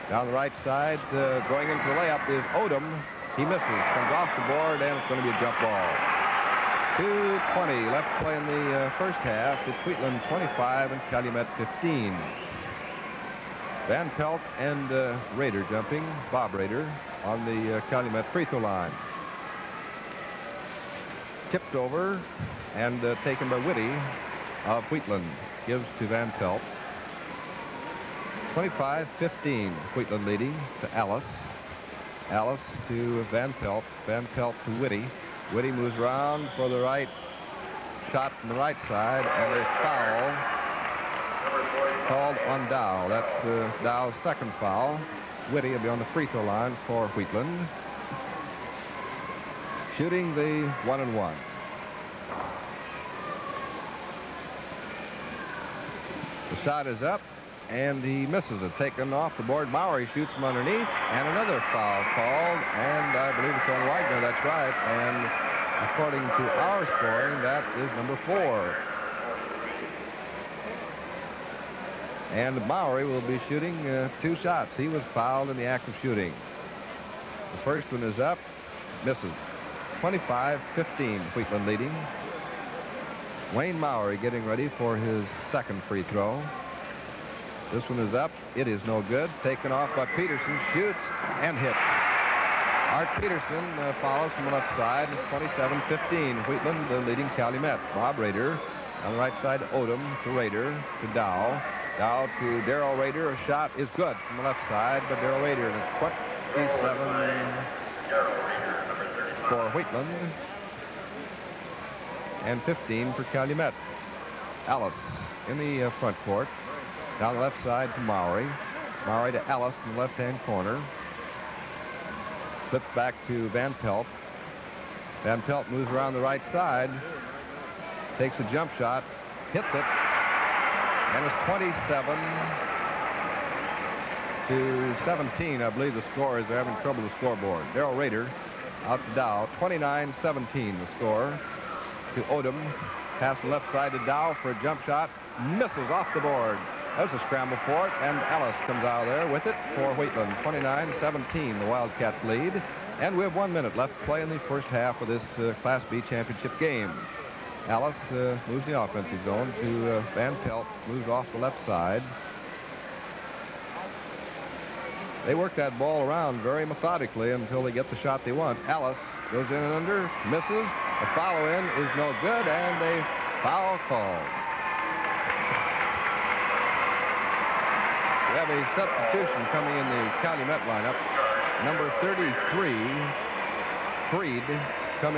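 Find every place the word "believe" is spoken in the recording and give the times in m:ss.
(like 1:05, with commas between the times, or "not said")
1:03, 2:15.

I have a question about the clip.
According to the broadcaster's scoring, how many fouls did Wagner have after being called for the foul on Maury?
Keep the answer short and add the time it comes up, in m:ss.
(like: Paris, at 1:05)
4, at 1:07.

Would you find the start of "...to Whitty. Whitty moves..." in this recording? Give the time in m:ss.
0:34.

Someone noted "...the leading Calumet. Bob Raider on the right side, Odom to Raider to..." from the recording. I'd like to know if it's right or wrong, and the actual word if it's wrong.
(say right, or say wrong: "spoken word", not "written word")
right.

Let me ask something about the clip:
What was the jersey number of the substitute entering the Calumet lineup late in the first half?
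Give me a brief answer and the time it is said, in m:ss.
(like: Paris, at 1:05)
33, at 3:01.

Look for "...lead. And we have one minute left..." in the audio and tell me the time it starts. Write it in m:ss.
2:32.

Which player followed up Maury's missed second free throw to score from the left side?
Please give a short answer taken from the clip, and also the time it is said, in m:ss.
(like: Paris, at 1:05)
Art Peterson, at 1:31.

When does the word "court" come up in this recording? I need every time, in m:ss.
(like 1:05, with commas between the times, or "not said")
1:56.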